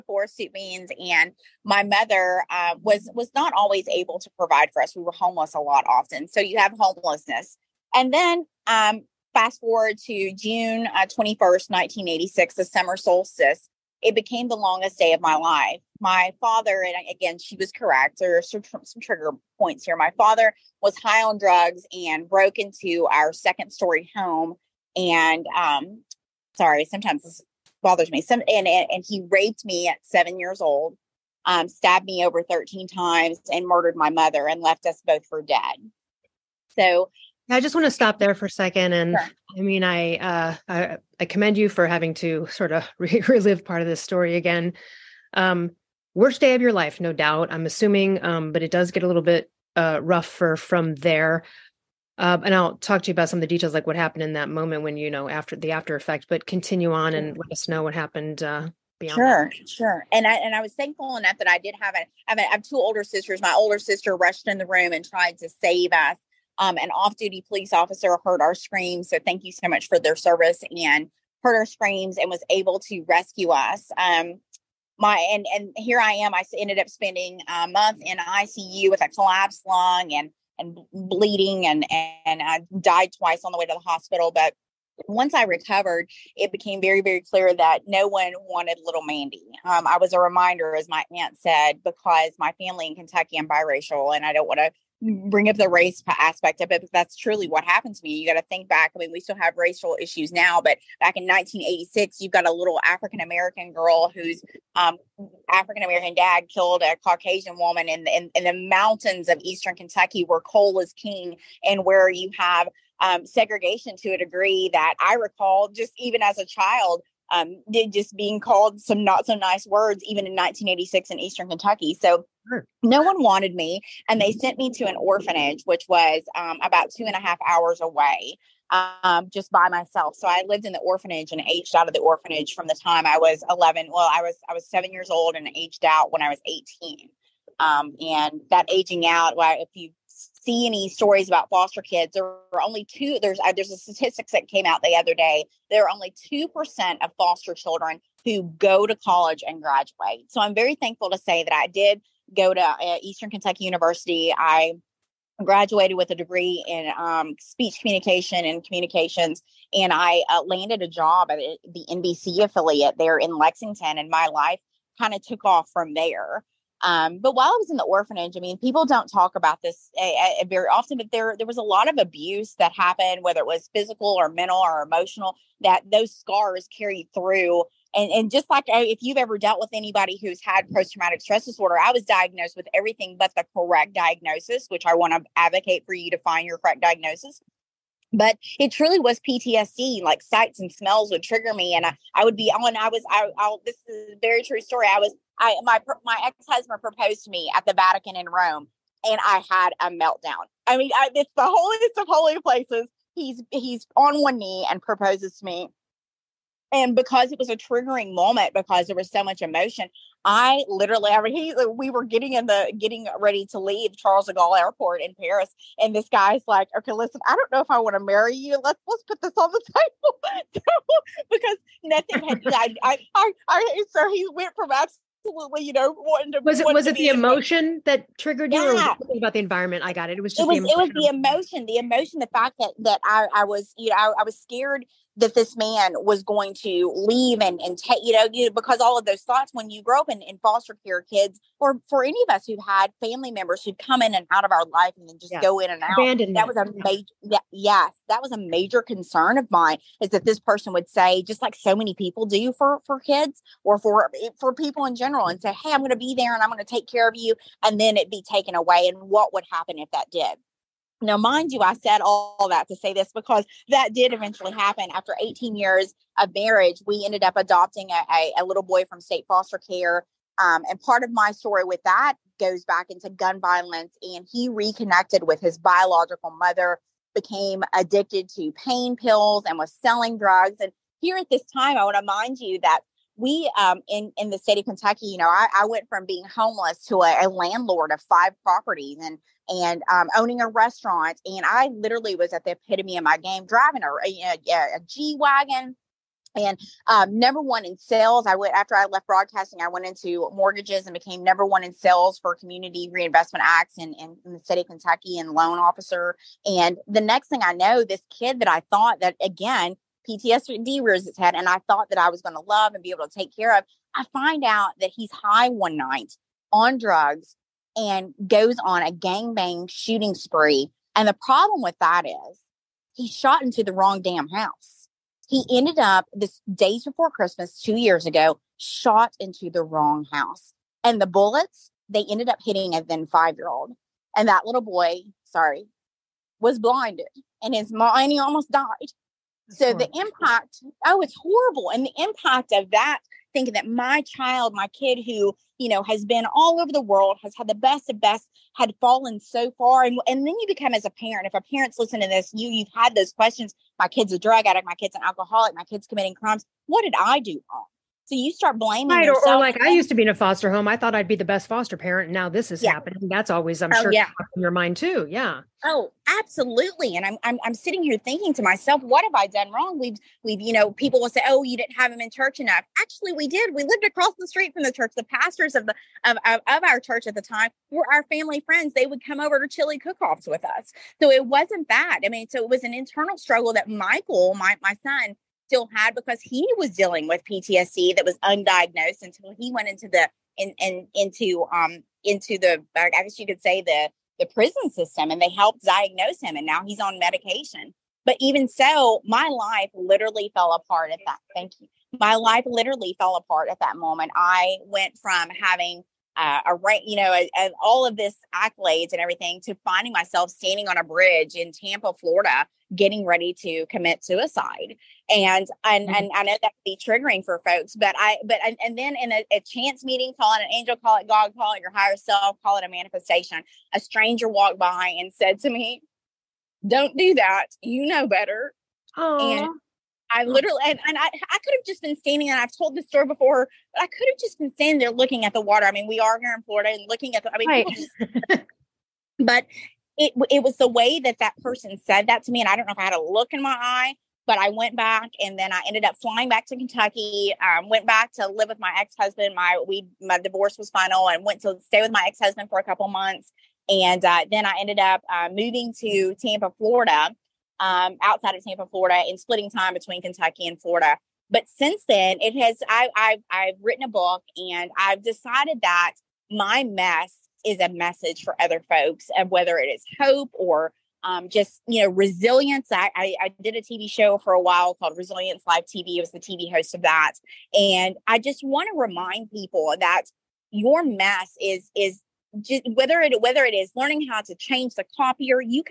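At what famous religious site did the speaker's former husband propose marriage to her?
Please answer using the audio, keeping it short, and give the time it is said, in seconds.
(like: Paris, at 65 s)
The Vatican, at 197 s.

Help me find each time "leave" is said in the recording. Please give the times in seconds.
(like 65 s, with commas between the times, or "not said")
213 s, 236 s.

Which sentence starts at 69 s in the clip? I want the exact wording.
So thank you so much for their service and heard our screams and was able to rescue us.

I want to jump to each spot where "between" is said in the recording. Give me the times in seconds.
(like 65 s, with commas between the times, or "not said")
459 s.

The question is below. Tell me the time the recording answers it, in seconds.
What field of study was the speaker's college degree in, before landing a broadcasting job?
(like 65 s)
157 s.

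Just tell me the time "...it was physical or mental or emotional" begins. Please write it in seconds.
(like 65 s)
173 s.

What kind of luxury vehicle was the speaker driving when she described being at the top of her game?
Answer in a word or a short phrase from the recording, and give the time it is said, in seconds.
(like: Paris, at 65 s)
G wagon, at 294 s.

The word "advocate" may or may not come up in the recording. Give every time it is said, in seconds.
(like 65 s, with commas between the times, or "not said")
185 s.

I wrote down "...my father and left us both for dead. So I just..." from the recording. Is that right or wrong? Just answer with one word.
wrong.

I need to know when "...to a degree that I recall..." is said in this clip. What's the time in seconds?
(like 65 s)
113 s.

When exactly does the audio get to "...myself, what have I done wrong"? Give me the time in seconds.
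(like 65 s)
368 s.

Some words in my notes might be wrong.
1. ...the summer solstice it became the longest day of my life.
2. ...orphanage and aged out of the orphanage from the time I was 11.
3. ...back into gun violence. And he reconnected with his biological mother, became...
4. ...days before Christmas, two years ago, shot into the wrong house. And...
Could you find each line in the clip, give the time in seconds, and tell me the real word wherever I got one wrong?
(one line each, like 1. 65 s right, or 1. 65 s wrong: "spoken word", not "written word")
1. 12 s right
2. 130 s right
3. 272 s right
4. 326 s right.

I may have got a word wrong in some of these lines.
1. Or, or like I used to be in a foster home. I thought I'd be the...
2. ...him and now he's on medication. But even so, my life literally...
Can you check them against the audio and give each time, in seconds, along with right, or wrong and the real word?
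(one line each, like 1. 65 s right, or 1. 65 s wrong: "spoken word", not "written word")
1. 359 s right
2. 396 s right.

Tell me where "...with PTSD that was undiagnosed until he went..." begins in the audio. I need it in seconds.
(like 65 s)
387 s.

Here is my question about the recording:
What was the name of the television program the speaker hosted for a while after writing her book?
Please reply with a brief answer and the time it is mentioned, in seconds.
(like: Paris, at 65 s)
Resilience Live TV, at 474 s.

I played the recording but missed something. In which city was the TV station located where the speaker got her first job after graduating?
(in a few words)
Lexington.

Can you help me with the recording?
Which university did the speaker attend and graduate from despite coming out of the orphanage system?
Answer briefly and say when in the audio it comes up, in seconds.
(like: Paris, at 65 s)
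Eastern Kentucky University, at 153 s.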